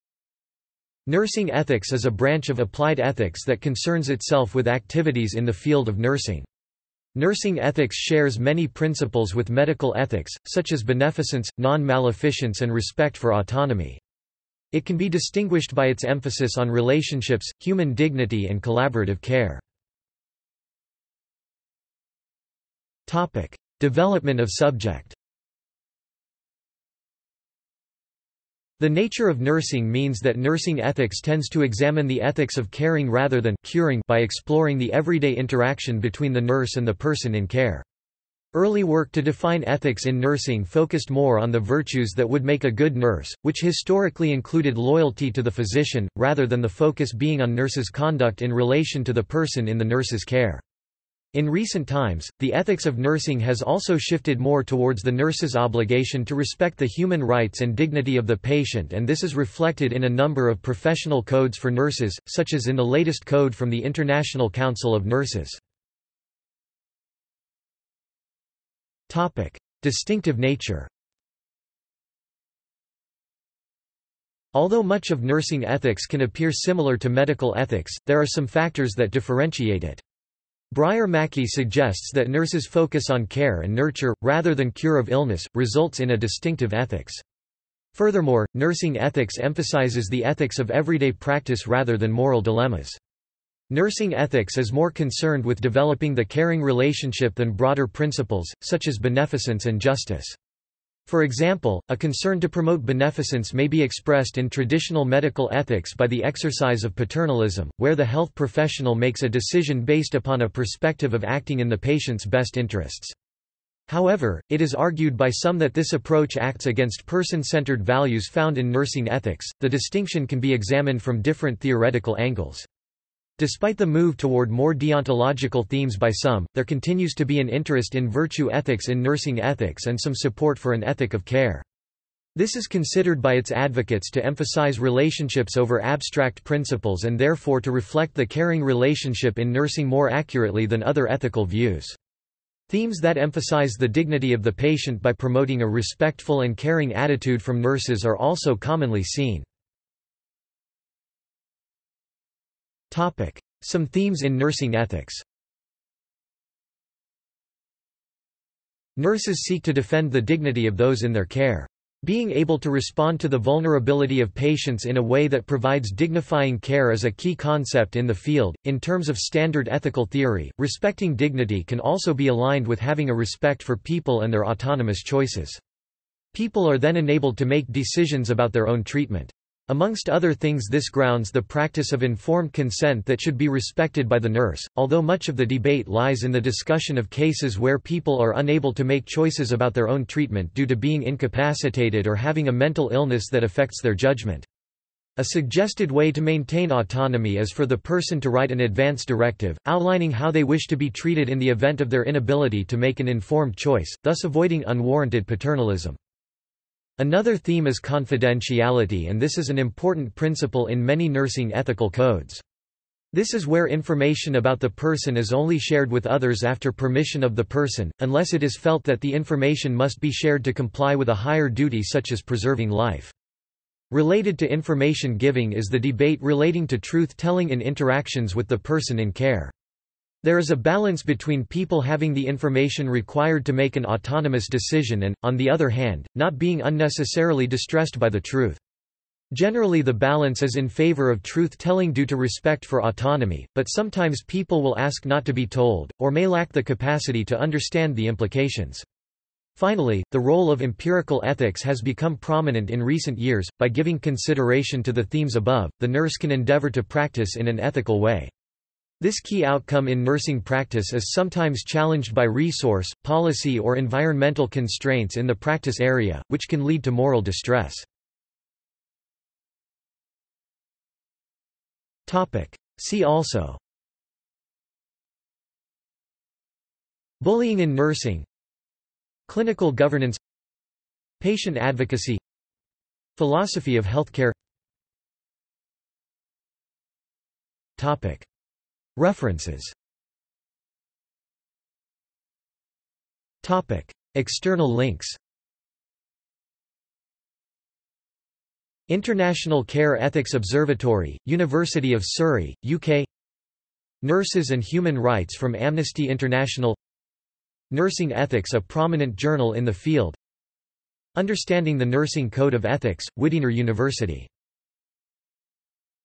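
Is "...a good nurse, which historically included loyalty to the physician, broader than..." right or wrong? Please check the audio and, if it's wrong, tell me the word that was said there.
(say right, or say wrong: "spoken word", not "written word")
wrong: "rather", not "broader".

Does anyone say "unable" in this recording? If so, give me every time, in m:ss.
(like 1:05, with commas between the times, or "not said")
3:08.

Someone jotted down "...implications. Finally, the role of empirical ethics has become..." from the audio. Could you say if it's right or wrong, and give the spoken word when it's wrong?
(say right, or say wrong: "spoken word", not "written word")
right.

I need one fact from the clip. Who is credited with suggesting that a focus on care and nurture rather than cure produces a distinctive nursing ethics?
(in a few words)
Breyer Mackey.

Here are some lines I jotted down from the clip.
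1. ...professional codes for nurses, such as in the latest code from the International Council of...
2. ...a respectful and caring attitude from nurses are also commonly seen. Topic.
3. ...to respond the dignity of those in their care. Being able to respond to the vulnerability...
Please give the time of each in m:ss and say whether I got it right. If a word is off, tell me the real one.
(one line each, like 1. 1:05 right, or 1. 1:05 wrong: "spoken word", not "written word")
1. 1:00 right
2. 2:25 right
3. 2:39 wrong: "defend", not "respond".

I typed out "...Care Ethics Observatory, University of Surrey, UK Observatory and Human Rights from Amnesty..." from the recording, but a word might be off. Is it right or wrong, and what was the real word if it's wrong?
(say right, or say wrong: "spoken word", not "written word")
wrong: "Nurses", not "Observatory".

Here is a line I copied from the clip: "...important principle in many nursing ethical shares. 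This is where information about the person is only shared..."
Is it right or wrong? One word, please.
wrong.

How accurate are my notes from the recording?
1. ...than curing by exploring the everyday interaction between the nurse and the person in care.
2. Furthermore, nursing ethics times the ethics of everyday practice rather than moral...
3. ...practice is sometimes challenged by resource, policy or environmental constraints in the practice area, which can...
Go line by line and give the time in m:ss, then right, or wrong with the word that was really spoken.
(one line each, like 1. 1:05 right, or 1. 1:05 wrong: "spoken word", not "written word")
1. 0:33 right
2. 1:27 wrong: "emphasizes", not "times"
3. 4:20 right.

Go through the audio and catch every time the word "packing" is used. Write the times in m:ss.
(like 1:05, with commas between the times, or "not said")
not said.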